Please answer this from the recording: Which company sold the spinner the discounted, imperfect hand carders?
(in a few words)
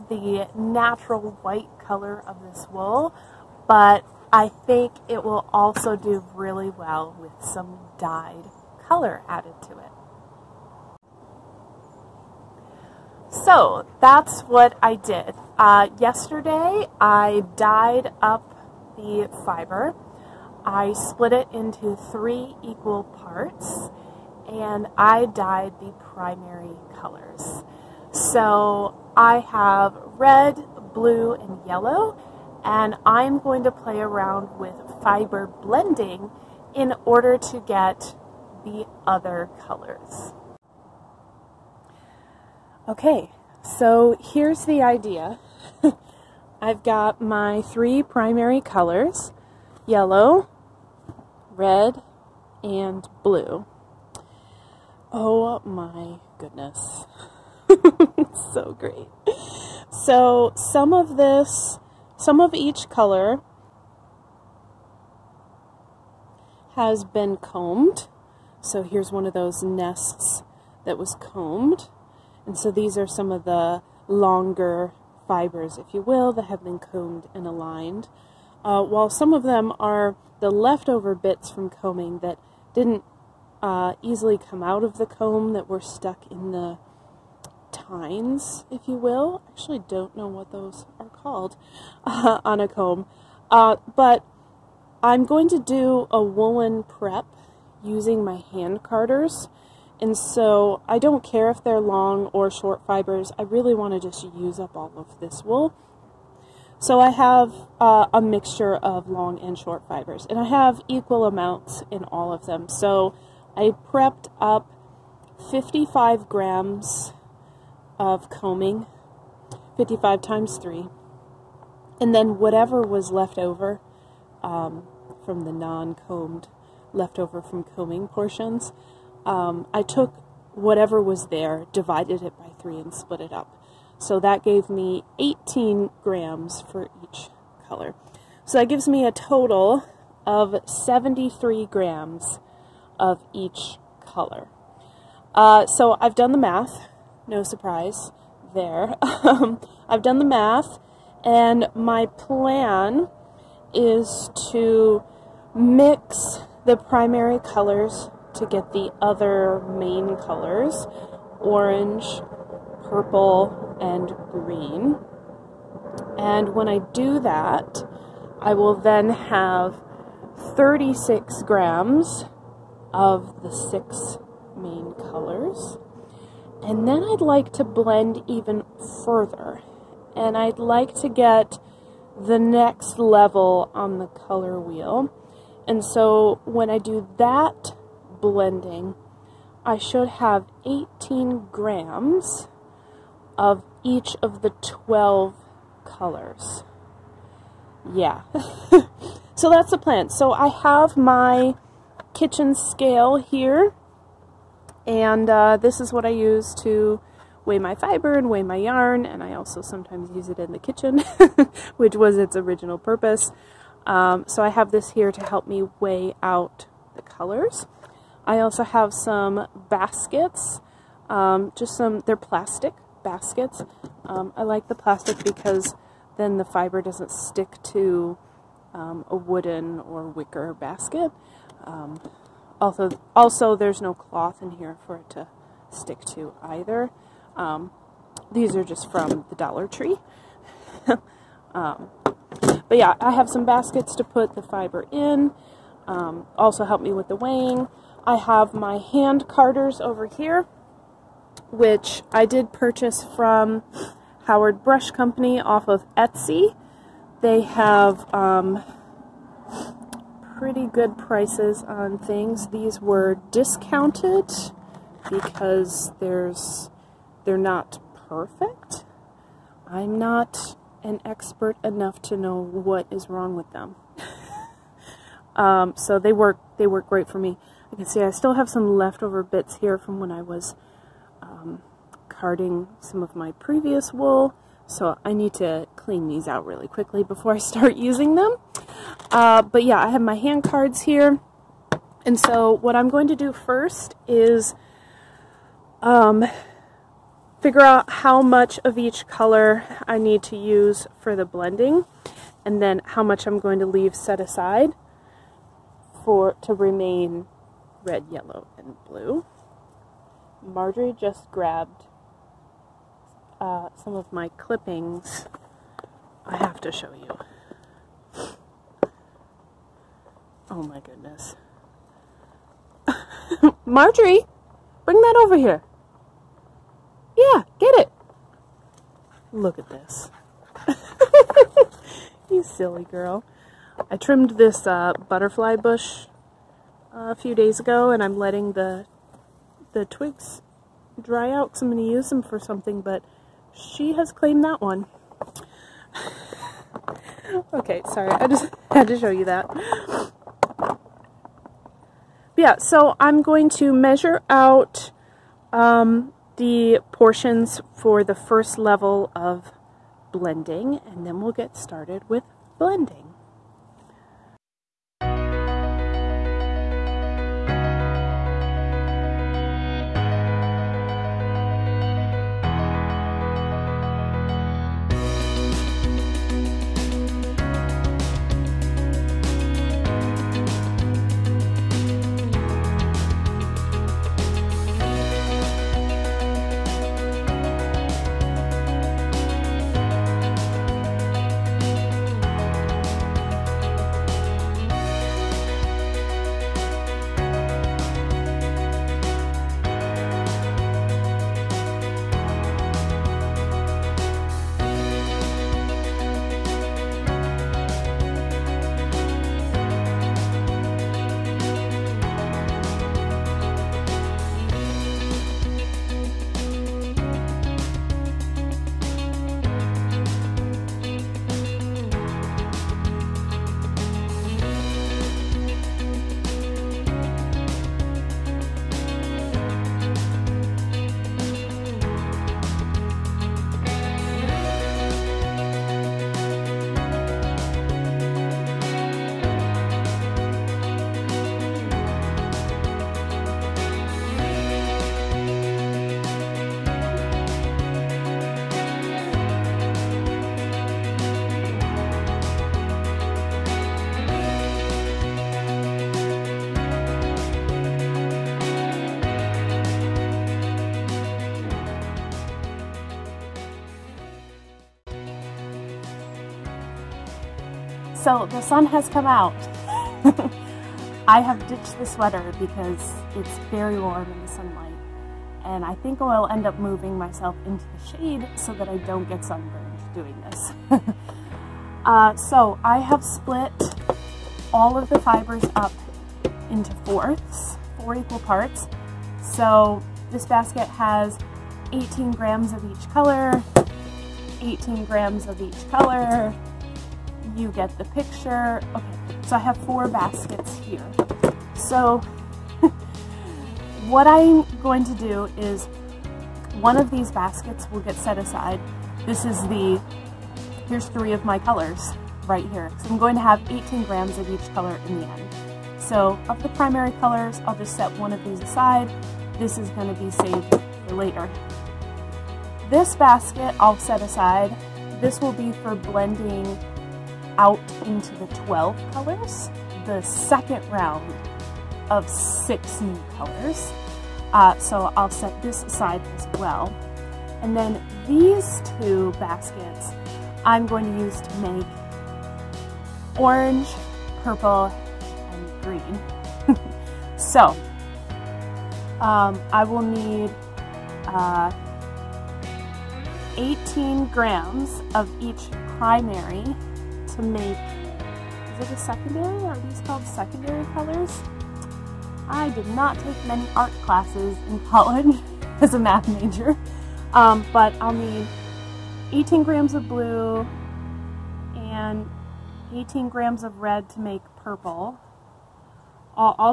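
Howard Brush Company.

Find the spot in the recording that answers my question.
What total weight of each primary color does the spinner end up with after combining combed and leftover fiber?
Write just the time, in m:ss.
2:20.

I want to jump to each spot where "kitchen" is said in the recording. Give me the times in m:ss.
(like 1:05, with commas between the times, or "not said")
3:22, 3:30.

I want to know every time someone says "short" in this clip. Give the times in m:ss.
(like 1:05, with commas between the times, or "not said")
1:42, 1:49.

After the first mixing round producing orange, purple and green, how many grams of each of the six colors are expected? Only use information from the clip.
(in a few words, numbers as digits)
36 grams.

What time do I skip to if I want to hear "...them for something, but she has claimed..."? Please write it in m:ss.
5:42.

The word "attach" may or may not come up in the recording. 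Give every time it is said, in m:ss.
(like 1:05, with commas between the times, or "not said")
not said.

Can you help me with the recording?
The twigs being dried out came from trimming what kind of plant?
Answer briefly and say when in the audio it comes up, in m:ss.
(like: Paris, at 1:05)
butterfly bush, at 5:35.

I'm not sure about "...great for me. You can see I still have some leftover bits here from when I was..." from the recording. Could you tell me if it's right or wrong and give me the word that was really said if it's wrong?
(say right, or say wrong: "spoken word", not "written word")
right.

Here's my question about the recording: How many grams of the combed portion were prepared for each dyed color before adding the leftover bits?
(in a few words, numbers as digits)
55 grams.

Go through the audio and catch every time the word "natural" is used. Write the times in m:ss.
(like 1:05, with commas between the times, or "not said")
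0:00.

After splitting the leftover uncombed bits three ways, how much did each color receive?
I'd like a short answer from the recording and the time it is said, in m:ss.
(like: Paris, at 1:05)
18 grams, at 2:15.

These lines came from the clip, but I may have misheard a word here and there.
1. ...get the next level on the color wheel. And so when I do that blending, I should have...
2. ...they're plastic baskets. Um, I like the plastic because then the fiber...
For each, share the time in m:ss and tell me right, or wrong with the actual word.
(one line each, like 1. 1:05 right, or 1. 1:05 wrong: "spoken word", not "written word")
1. 3:01 right
2. 3:42 right.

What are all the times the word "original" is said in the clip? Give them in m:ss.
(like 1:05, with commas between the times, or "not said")
3:32.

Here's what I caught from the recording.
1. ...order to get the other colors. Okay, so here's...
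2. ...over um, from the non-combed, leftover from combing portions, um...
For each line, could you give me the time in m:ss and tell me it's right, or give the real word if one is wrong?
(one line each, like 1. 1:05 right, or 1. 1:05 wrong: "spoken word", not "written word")
1. 0:37 right
2. 2:03 right.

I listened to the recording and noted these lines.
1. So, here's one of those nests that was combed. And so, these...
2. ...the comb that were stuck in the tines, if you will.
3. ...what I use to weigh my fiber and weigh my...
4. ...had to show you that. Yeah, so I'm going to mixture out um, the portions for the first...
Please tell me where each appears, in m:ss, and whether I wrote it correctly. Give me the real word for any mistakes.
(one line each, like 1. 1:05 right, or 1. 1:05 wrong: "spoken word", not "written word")
1. 1:08 right
2. 1:24 right
3. 3:25 right
4. 5:48 wrong: "measure", not "mixture".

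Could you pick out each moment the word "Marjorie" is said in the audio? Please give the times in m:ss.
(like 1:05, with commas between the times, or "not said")
5:10, 5:23.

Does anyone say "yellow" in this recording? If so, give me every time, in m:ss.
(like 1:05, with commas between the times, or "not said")
0:31, 0:49, 5:08.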